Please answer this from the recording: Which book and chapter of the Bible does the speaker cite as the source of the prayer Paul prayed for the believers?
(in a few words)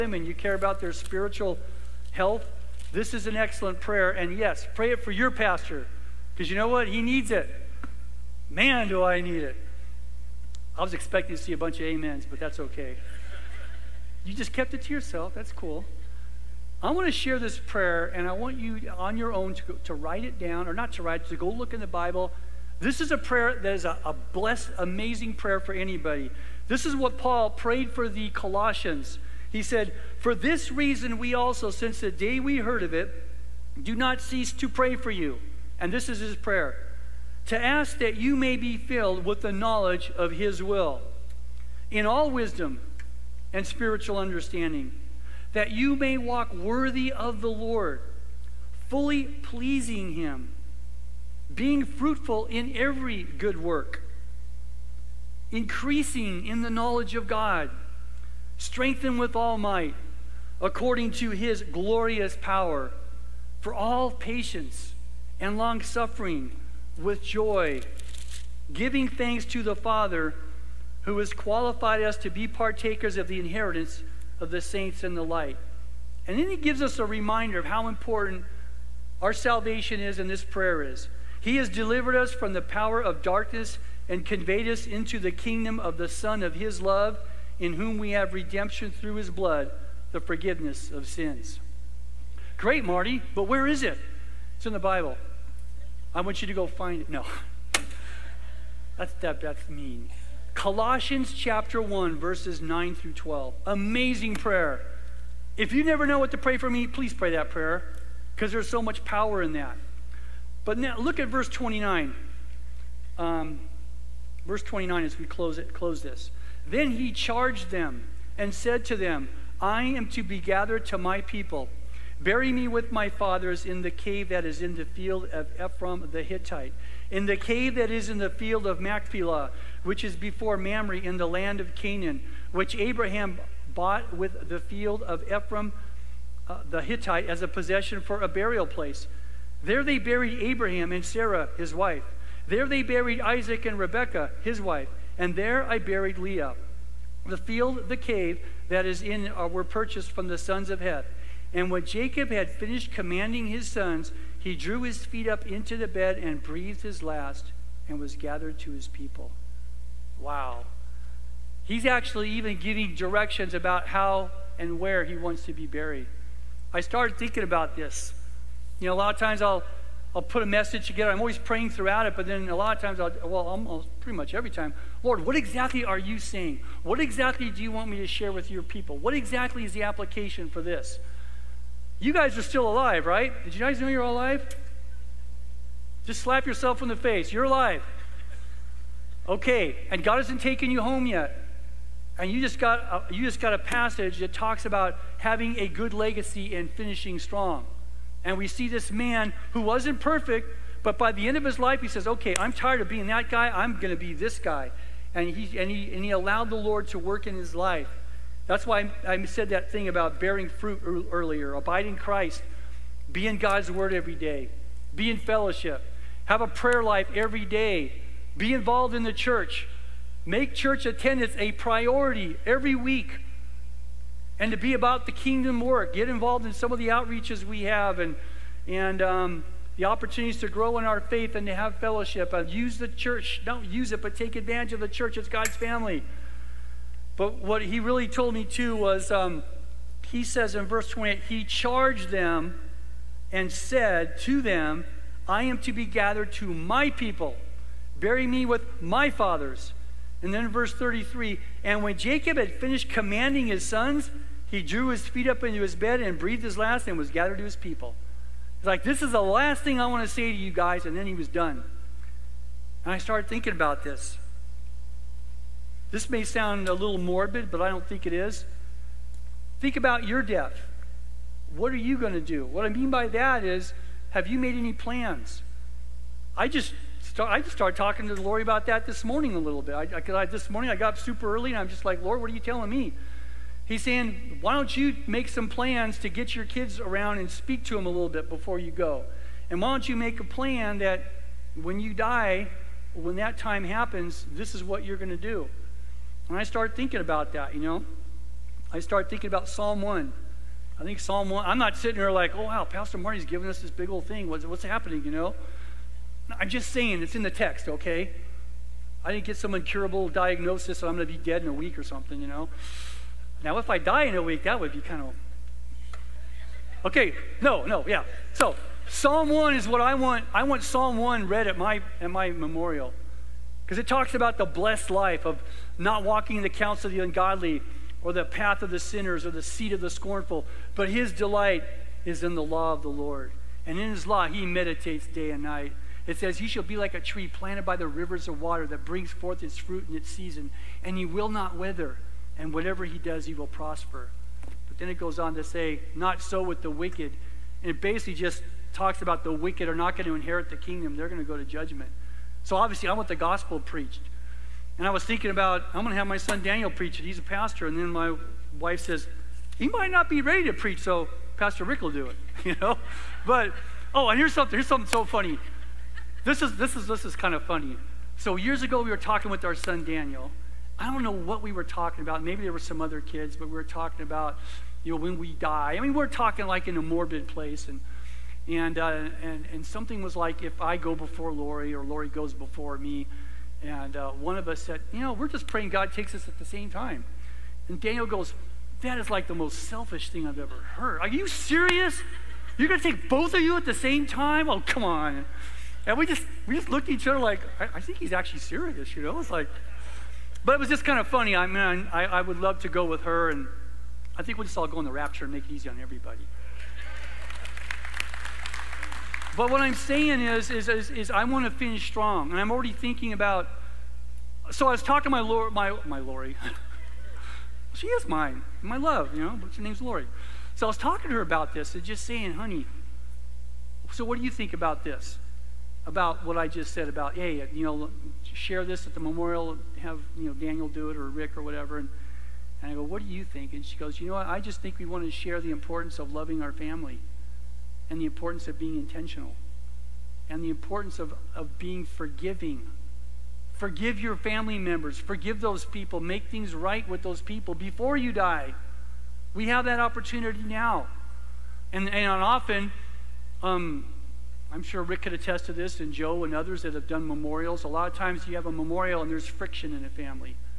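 Colossians 1.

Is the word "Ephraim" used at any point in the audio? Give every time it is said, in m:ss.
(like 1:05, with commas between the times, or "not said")
2:05, 2:15.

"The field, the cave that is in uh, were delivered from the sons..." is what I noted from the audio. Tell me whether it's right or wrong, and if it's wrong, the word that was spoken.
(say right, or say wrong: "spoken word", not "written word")
wrong: "purchased", not "delivered".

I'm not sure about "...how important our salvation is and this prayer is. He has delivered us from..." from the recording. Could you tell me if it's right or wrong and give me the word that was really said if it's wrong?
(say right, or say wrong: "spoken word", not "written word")
right.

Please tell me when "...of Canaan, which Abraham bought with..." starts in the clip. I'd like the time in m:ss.
2:11.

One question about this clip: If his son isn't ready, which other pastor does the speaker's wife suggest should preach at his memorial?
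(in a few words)
Pastor Rick.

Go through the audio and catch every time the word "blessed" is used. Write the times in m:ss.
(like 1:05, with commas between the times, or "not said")
0:24, 5:24.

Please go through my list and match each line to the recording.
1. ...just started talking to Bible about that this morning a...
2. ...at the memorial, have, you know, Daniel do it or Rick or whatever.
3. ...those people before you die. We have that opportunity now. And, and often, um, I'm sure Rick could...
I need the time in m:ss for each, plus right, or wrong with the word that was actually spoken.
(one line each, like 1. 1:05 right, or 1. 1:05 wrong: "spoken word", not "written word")
1. 4:37 wrong: "Lori", not "Bible"
2. 7:08 right
3. 7:27 right.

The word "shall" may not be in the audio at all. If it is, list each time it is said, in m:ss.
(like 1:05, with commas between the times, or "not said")
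5:36.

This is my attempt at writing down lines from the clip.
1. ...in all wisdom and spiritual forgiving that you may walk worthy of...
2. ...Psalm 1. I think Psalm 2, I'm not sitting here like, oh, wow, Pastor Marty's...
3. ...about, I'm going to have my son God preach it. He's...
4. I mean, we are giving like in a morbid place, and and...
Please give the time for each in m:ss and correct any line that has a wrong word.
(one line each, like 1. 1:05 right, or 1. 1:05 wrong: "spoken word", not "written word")
1. 0:41 wrong: "understanding", not "forgiving"
2. 4:59 wrong: "1", not "2"
3. 5:55 wrong: "Daniel", not "God"
4. 6:15 wrong: "talking", not "giving".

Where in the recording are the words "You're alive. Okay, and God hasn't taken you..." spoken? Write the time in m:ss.
3:07.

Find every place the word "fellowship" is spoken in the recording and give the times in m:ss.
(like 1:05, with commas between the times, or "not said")
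3:35, 3:51.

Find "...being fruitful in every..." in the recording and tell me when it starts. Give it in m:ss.
0:51.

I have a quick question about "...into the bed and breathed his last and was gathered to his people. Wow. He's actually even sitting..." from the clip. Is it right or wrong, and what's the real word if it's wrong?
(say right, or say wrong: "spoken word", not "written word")
wrong: "giving", not "sitting".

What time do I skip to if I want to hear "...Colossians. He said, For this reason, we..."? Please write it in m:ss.
0:28.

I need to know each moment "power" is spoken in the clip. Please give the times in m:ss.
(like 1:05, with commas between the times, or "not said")
1:02, 1:22, 1:49.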